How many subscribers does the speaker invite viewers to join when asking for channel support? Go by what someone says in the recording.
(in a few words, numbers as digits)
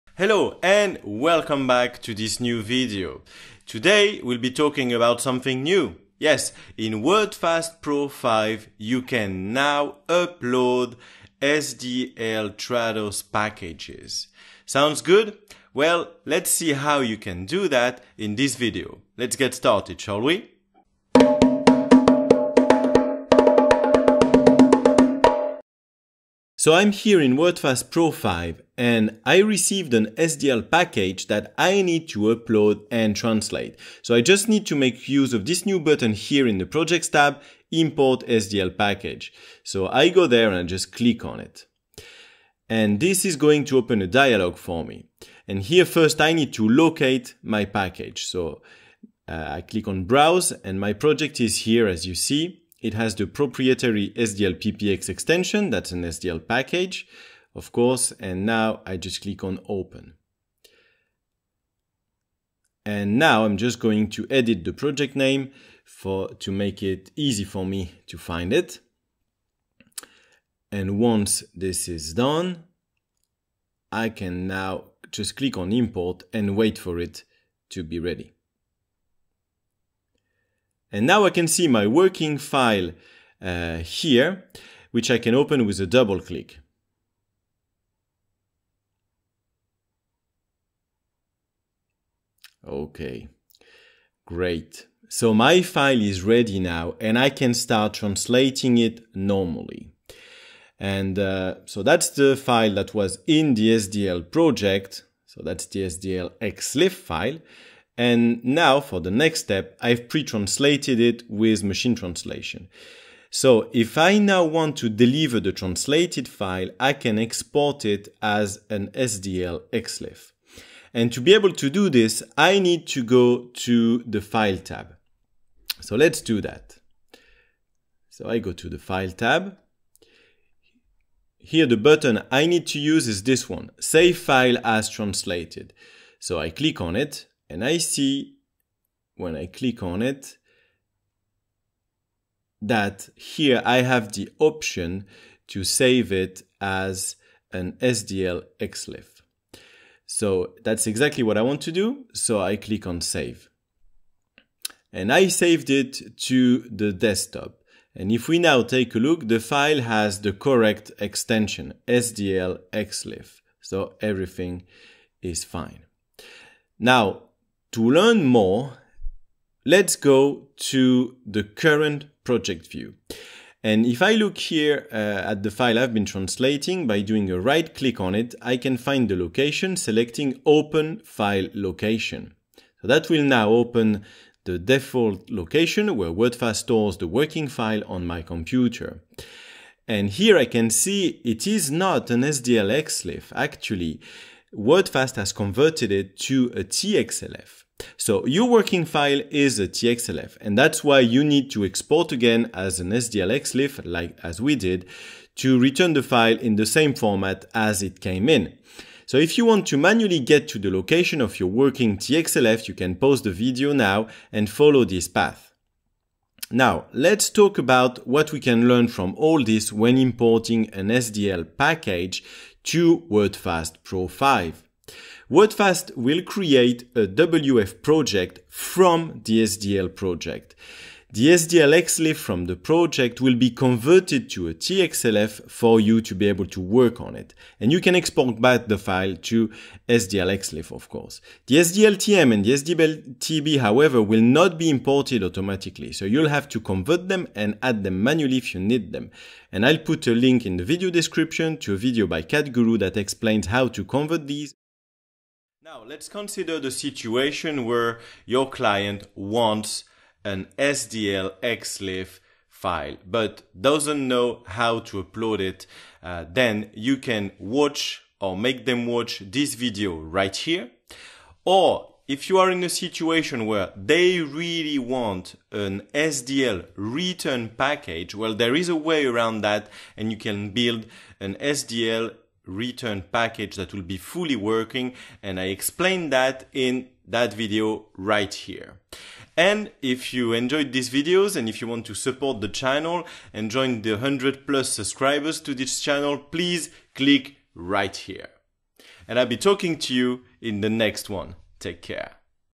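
100 plus.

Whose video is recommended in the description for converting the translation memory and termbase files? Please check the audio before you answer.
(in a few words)
CAT Guru.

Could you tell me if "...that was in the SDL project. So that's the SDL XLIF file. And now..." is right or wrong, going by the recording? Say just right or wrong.
right.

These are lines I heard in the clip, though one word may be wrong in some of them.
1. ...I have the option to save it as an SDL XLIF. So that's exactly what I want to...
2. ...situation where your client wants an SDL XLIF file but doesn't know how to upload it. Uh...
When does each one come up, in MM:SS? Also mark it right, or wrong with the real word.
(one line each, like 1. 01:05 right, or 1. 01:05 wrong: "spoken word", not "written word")
1. 02:23 right
2. 04:16 right.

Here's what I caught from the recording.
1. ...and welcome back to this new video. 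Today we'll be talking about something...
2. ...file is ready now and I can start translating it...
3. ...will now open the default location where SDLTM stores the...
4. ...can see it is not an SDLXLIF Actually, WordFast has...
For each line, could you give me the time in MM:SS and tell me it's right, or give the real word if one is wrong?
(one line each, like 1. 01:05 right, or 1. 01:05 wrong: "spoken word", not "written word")
1. 00:00 right
2. 01:35 right
3. 03:03 wrong: "WordFast", not "SDLTM"
4. 03:10 right.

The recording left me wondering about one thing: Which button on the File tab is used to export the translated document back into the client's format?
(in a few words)
Save File as Translated.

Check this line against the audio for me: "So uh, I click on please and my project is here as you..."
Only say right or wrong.
wrong.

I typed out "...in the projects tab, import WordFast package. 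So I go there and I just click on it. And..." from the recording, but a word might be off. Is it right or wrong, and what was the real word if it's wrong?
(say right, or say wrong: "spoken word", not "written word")
wrong: "SDL", not "WordFast".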